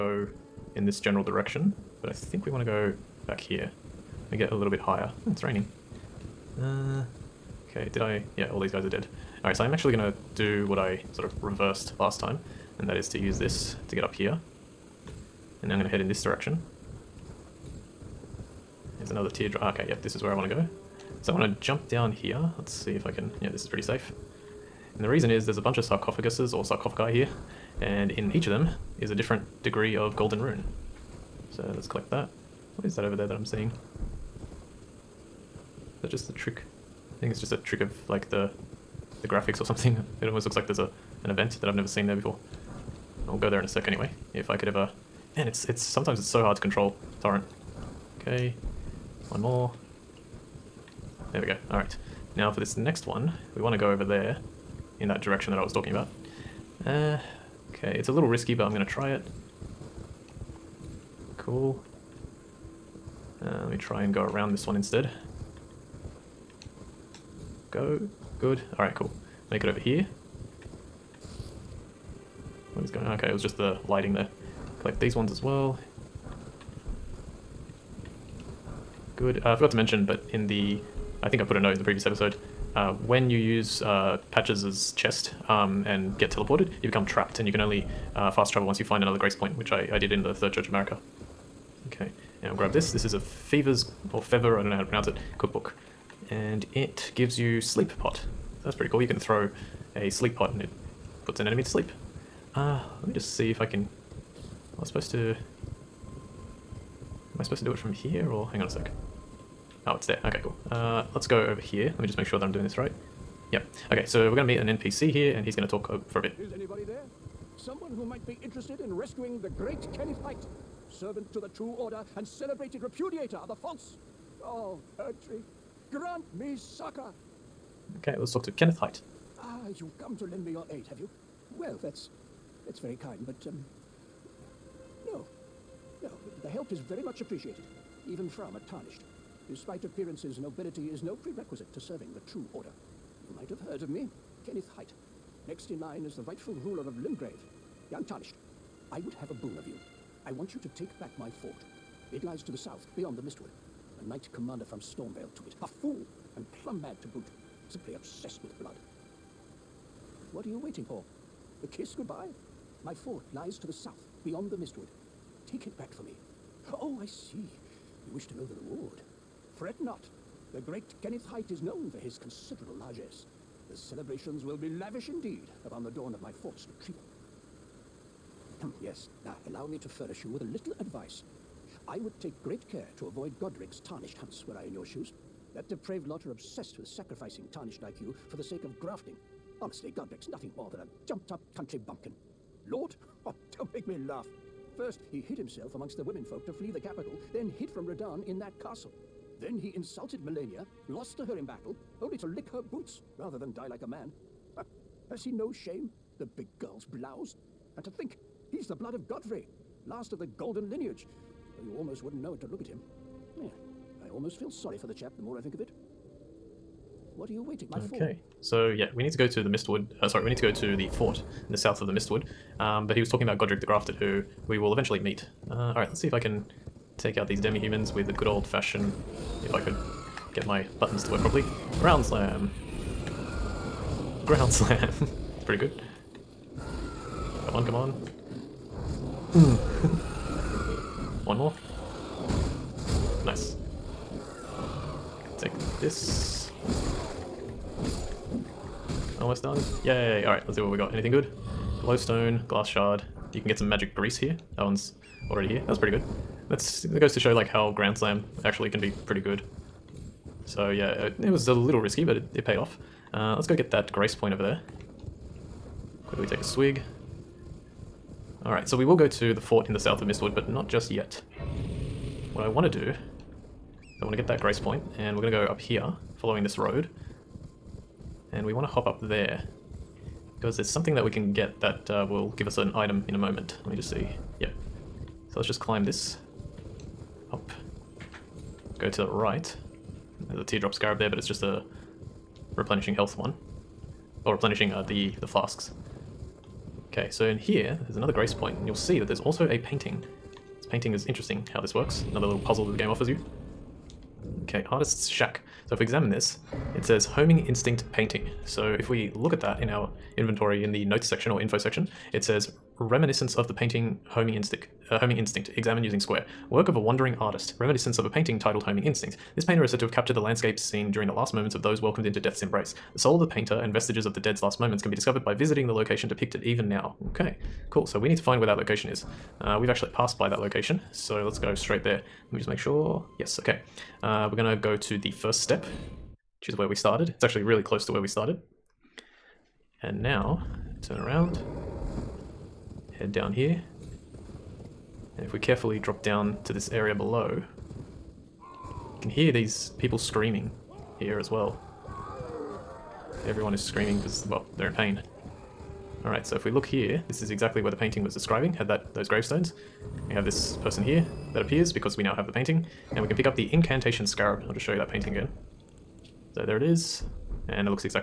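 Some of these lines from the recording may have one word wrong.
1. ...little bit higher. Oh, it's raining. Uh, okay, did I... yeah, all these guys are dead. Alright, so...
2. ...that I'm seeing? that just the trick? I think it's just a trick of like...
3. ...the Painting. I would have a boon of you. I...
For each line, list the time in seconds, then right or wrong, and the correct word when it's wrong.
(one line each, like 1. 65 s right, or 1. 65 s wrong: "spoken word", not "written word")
1. 4 s right
2. 33 s right
3. 147 s wrong: "Untarnished", not "Painting".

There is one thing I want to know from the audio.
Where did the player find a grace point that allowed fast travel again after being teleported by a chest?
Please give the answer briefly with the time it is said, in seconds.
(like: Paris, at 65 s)
Third Church of Marika, at 90 s.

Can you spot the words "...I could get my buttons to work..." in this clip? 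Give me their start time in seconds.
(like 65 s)
229 s.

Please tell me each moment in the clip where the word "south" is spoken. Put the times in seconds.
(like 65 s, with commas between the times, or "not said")
152 s, 163 s, 221 s, 269 s.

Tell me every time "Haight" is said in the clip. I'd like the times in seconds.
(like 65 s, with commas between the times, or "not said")
120 s, 128 s, 144 s, 171 s.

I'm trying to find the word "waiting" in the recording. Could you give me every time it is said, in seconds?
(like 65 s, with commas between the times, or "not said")
160 s, 217 s.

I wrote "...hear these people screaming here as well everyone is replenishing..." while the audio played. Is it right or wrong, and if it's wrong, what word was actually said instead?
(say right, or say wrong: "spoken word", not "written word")
wrong: "screaming", not "replenishing".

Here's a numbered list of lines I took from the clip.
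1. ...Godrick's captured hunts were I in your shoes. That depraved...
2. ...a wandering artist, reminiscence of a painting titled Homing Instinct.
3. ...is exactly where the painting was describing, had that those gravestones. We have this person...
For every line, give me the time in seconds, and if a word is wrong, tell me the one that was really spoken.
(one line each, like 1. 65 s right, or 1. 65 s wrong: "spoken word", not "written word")
1. 183 s wrong: "tarnished", not "captured"
2. 316 s right
3. 357 s right.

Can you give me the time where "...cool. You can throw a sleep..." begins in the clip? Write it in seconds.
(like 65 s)
98 s.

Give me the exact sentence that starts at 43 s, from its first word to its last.
I'll go there in a sec anyway.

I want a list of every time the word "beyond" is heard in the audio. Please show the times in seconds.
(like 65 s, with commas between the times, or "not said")
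152 s, 164 s.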